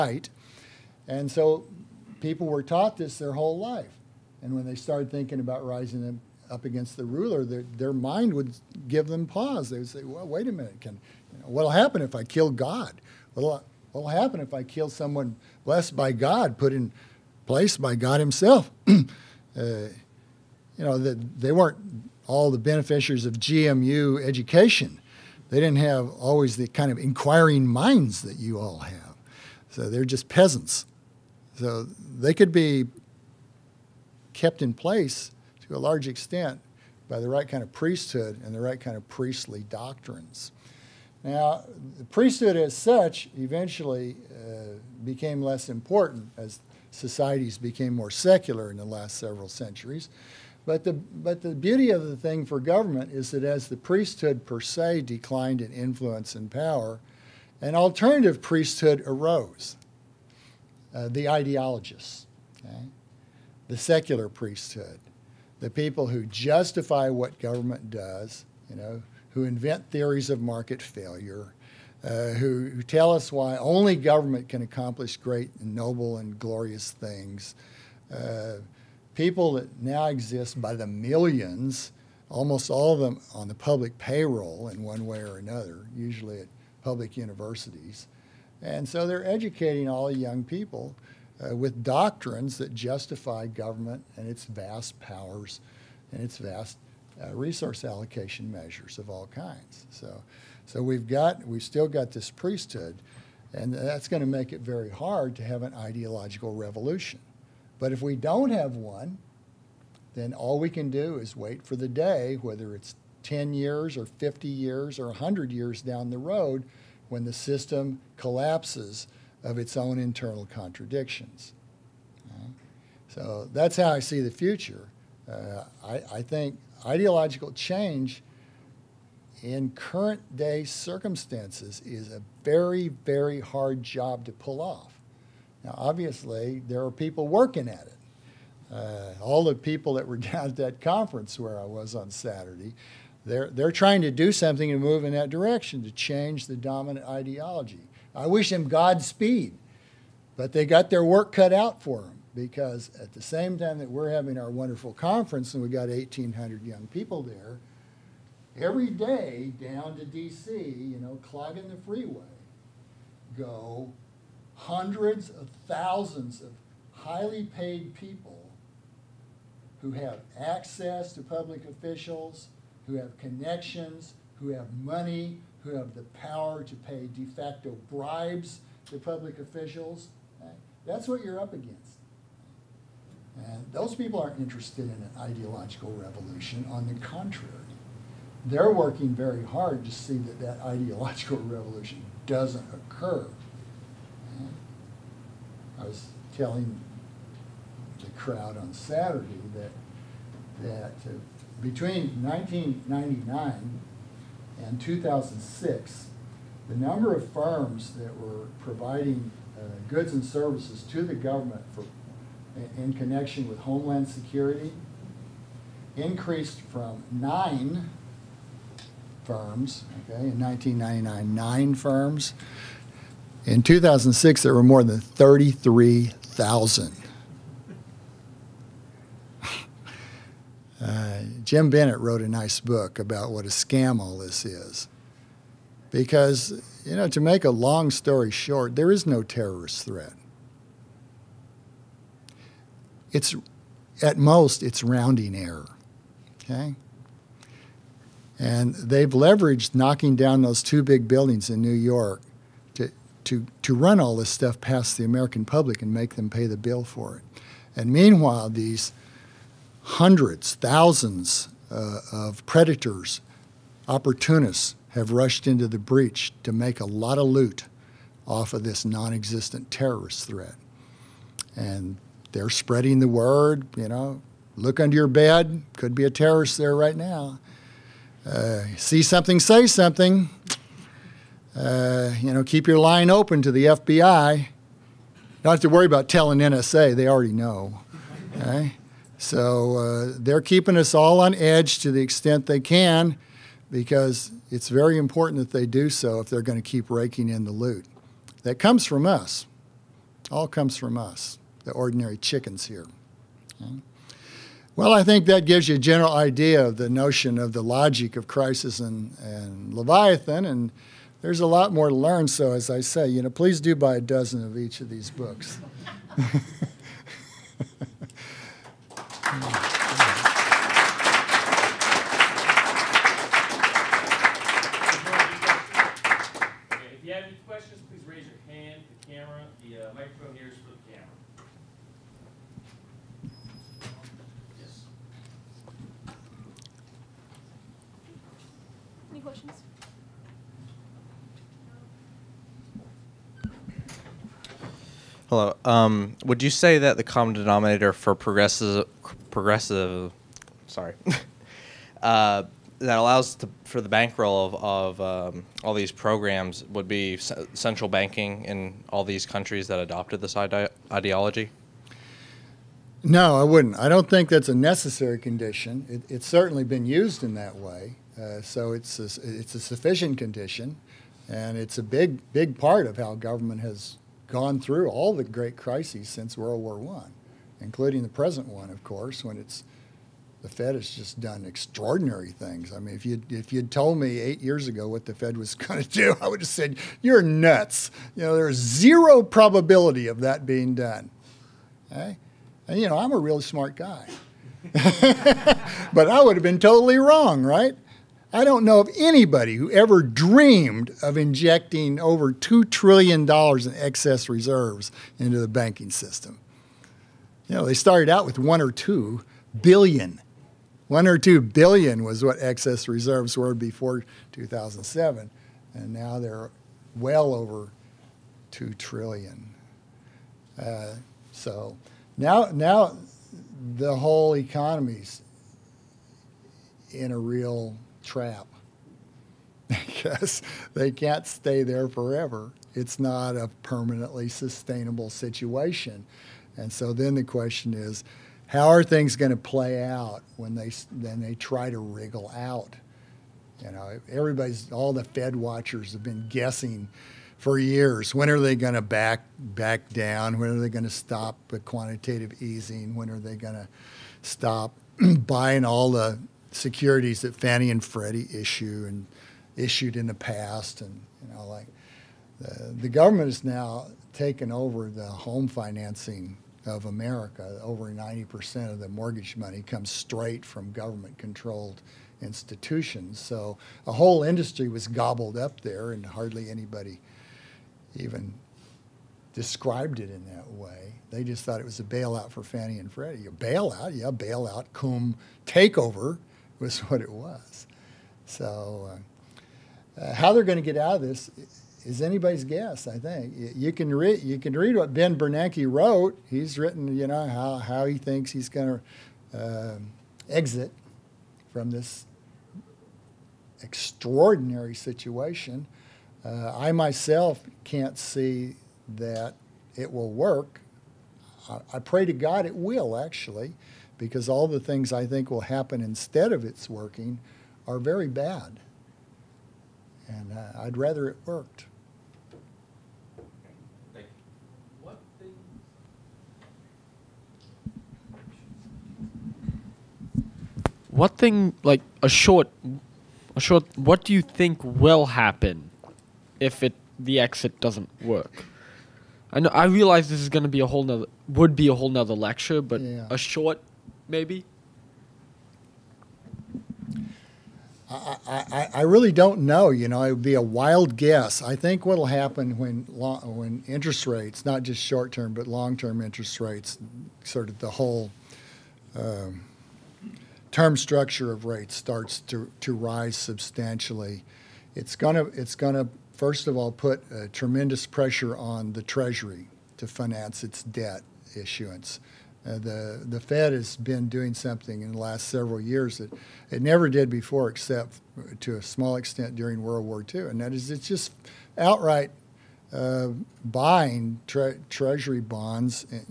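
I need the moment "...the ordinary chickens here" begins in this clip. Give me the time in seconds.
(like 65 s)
301 s.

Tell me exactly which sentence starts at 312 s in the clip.
So, as I say, you know, please do buy a dozen of each of these books.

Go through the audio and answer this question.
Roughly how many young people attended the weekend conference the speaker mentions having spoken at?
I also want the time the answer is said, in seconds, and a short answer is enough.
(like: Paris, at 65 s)
1,800, at 155 s.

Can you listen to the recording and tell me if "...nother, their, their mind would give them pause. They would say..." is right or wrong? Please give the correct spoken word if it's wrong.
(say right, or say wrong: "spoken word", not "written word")
wrong: "ruler", not "nother".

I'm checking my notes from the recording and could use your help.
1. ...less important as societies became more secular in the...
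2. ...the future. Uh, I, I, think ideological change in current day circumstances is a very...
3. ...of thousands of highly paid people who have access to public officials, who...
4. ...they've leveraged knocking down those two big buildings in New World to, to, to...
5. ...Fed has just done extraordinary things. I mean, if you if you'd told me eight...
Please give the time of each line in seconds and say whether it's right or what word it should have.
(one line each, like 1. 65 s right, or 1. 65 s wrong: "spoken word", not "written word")
1. 45 s right
2. 124 s right
3. 165 s right
4. 248 s wrong: "York", not "World"
5. 380 s right.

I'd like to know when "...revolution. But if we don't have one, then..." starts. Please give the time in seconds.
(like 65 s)
106 s.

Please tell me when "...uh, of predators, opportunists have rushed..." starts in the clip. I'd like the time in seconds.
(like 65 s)
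261 s.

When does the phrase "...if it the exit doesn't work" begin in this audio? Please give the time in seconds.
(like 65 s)
536 s.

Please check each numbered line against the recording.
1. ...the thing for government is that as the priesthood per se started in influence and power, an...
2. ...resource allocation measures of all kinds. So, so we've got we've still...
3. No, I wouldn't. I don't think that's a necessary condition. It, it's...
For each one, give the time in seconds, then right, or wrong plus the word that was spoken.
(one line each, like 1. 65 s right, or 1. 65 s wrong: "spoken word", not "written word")
1. 52 s wrong: "declined", not "started"
2. 97 s right
3. 363 s right.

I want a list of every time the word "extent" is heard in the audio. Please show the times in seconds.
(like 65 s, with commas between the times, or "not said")
36 s, 292 s, 578 s.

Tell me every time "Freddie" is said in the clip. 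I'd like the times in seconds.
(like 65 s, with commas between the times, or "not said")
457 s, 482 s.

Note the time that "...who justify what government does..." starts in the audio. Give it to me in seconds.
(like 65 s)
66 s.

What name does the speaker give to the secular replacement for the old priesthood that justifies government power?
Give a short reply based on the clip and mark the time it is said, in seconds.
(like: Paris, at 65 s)
The ideologists, at 61 s.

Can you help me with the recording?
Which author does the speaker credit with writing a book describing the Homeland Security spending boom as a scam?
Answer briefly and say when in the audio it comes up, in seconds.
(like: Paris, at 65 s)
Jim Bennett, at 231 s.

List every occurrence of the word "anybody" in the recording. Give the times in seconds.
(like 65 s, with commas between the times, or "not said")
398 s, 476 s, 492 s.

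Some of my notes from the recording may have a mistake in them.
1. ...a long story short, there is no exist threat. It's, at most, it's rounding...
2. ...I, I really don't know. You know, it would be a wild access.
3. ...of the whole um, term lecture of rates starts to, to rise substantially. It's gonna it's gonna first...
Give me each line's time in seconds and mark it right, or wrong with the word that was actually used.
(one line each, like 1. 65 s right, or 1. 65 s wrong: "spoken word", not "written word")
1. 237 s wrong: "terrorist", not "exist"
2. 548 s wrong: "guess", not "access"
3. 557 s wrong: "structure", not "lecture".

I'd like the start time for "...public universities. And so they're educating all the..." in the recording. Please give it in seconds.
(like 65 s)
86 s.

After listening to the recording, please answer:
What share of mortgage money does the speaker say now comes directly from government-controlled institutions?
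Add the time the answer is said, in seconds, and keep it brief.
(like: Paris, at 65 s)
Over 90%, at 467 s.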